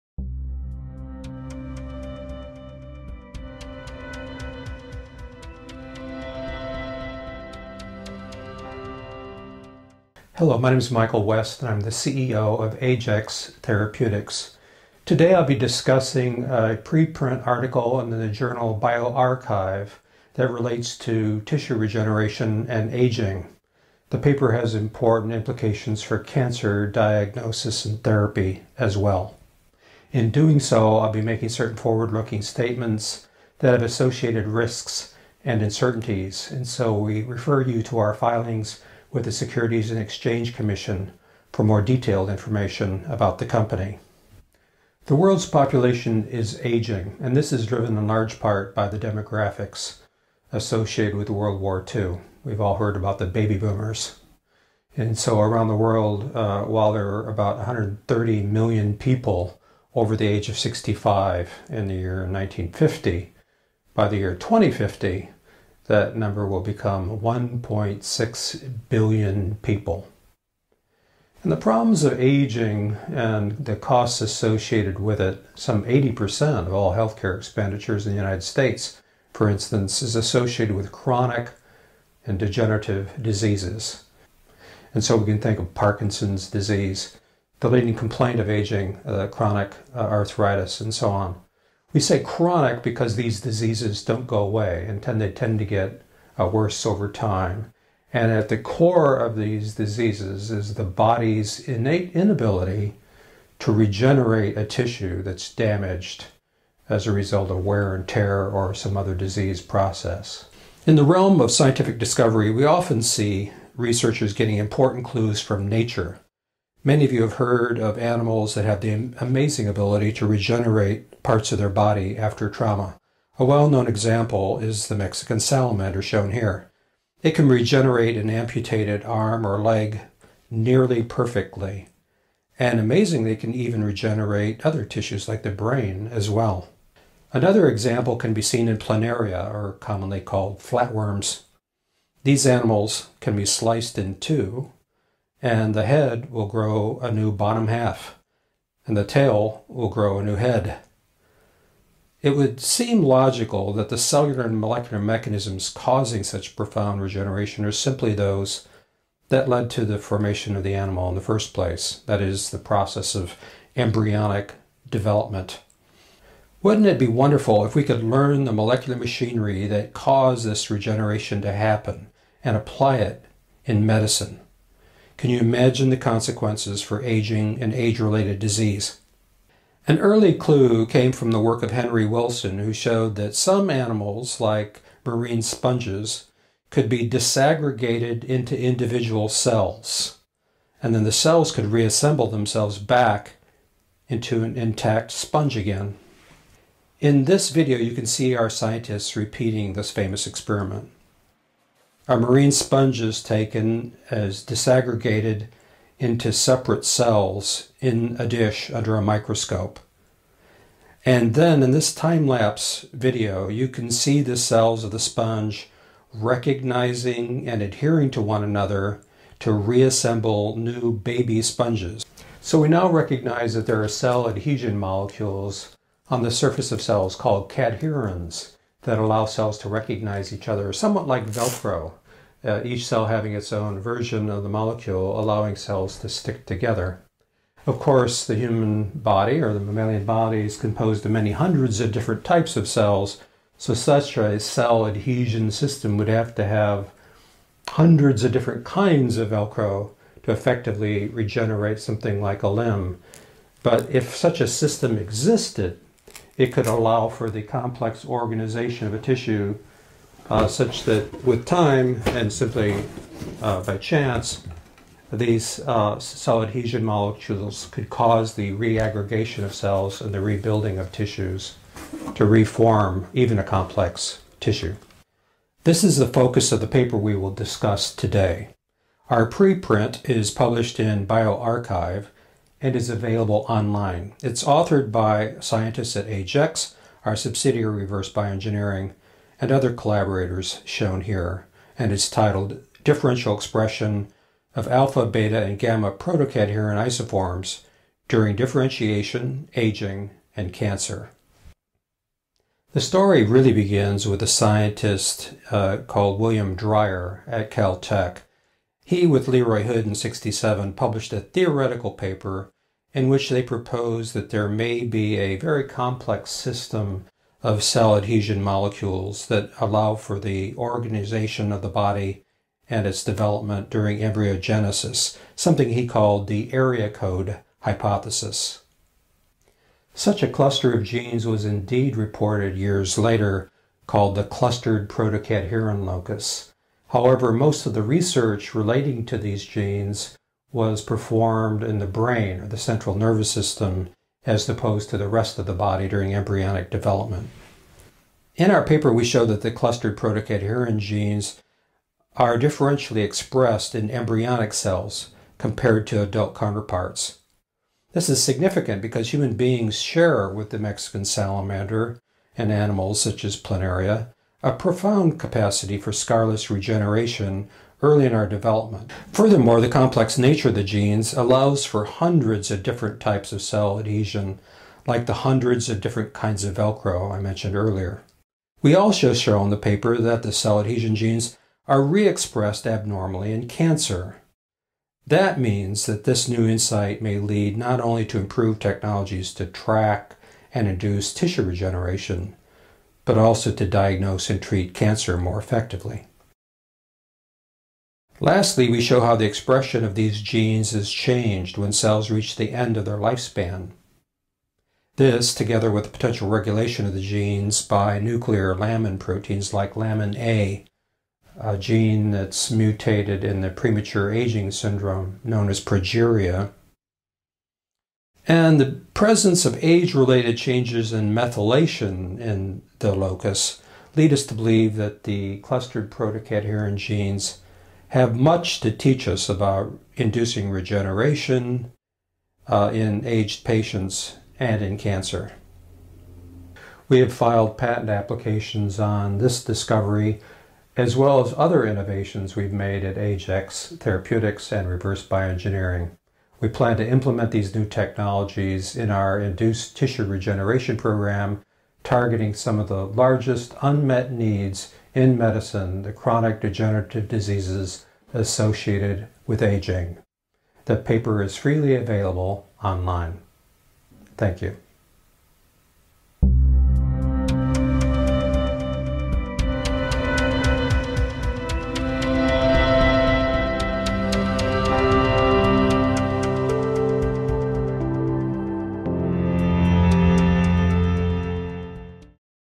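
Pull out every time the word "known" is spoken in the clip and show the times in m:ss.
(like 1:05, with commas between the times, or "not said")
2:03, 6:55.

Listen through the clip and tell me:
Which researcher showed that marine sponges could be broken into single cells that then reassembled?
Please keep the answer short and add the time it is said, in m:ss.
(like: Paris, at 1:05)
Henry Wilson, at 3:01.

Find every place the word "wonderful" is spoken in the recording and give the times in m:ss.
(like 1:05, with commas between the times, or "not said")
2:47.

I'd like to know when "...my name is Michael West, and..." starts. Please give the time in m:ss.
0:10.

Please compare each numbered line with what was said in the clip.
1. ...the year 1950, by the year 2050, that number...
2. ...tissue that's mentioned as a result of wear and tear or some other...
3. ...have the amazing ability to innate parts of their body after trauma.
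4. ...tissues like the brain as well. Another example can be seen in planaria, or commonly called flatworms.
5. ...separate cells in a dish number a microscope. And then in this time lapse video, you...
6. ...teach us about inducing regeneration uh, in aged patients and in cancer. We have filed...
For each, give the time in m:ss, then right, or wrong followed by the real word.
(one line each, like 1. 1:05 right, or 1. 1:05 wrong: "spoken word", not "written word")
1. 1:01 right
2. 1:44 wrong: "damaged", not "mentioned"
3. 1:58 wrong: "regenerate", not "innate"
4. 2:14 right
5. 3:26 wrong: "under", not "number"
6. 7:08 right.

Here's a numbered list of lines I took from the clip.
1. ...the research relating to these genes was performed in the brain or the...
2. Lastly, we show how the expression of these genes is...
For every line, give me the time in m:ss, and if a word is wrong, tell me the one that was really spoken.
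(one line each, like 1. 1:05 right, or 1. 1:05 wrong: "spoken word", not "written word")
1. 5:37 right
2. 6:38 right.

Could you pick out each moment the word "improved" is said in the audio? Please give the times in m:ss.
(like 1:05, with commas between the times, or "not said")
6:28.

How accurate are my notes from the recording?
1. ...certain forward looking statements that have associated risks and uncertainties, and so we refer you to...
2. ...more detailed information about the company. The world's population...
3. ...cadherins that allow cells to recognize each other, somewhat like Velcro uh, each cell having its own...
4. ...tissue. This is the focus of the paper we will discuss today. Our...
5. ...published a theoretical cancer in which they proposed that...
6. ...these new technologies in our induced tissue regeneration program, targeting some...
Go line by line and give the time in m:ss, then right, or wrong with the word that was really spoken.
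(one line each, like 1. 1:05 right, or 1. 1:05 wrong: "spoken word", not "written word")
1. 0:31 right
2. 0:41 right
3. 3:47 right
4. 4:34 right
5. 5:10 wrong: "paper", not "cancer"
6. 7:27 right.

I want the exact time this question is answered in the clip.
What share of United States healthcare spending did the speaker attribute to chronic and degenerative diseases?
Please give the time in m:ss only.
1:15.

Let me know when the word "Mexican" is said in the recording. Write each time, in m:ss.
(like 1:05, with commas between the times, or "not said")
2:04, 6:00.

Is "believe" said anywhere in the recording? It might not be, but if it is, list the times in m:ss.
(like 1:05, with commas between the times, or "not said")
7:04.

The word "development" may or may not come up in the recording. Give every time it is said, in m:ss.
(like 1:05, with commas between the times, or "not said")
2:44, 5:23, 5:46, 6:08.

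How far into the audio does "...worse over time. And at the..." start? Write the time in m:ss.
1:36.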